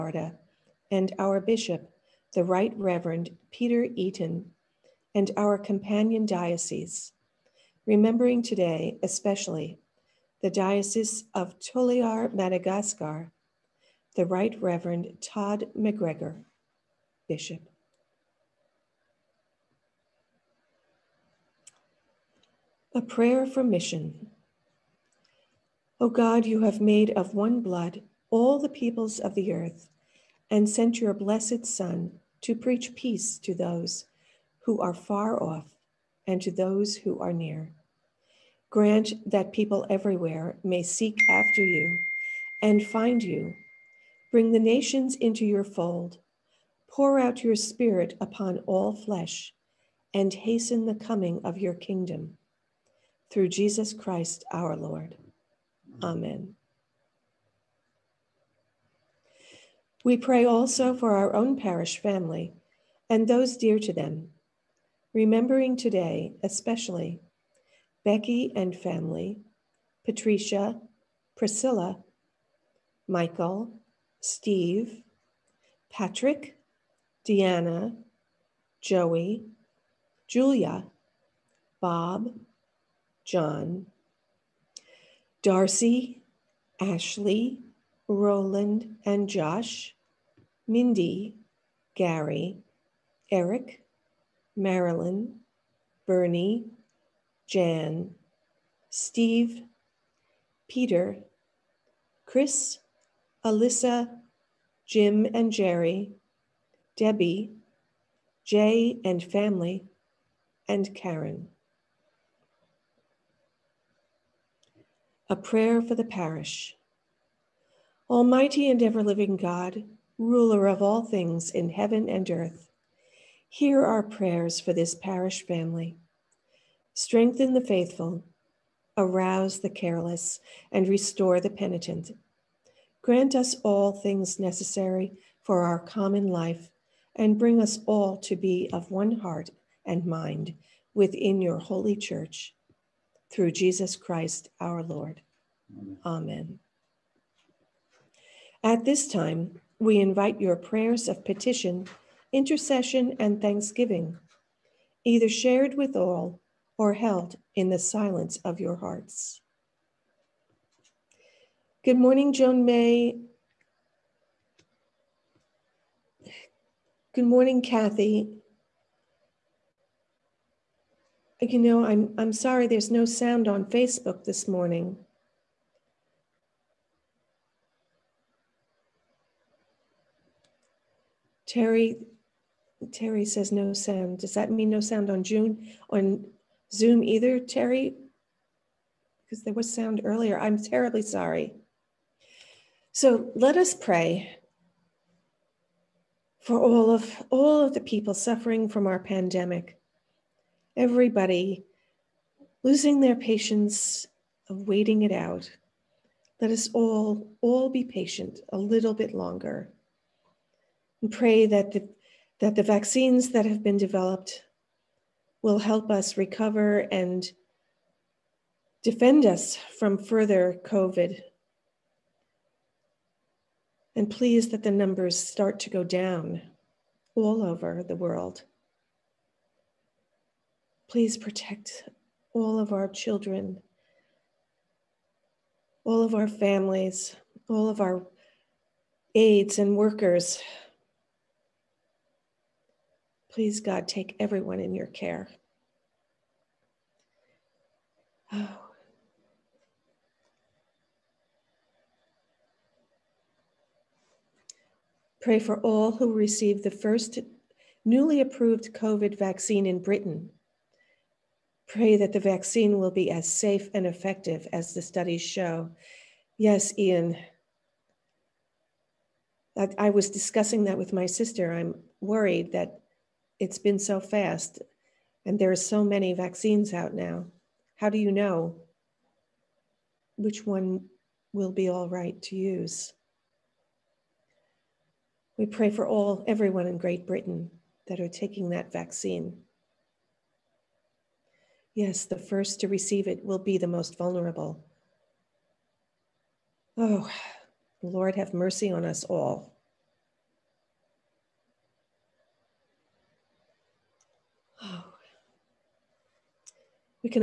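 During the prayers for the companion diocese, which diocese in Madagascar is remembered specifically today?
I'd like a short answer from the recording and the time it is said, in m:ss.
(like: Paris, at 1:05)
Toliar, at 0:10.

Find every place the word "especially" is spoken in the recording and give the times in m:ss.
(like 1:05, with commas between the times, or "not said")
0:09, 1:06.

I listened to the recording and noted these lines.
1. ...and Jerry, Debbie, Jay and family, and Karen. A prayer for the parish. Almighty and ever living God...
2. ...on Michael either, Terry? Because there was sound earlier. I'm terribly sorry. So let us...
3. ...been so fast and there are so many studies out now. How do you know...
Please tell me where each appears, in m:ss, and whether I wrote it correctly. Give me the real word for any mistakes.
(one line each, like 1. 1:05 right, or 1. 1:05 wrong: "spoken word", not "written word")
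1. 1:45 right
2. 3:05 wrong: "Zoom", not "Michael"
3. 4:33 wrong: "vaccines", not "studies".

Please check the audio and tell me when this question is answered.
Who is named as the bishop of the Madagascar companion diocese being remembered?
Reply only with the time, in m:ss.
0:15.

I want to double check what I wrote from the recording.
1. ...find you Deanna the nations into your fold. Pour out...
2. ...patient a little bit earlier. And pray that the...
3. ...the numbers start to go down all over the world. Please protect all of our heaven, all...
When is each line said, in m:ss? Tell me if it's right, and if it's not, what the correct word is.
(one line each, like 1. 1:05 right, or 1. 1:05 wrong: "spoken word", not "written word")
1. 0:42 wrong: "Bring", not "Deanna"
2. 3:27 wrong: "longer", not "earlier"
3. 3:44 wrong: "children", not "heaven".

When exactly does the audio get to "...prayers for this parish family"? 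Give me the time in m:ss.
2:04.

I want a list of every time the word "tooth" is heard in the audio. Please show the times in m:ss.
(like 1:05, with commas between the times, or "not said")
not said.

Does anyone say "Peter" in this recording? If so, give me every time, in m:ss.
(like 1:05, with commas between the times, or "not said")
0:03, 1:40.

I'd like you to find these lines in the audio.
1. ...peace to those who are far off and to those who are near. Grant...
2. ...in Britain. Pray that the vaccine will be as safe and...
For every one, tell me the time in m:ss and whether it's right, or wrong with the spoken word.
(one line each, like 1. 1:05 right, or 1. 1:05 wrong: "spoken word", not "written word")
1. 0:32 right
2. 4:19 right.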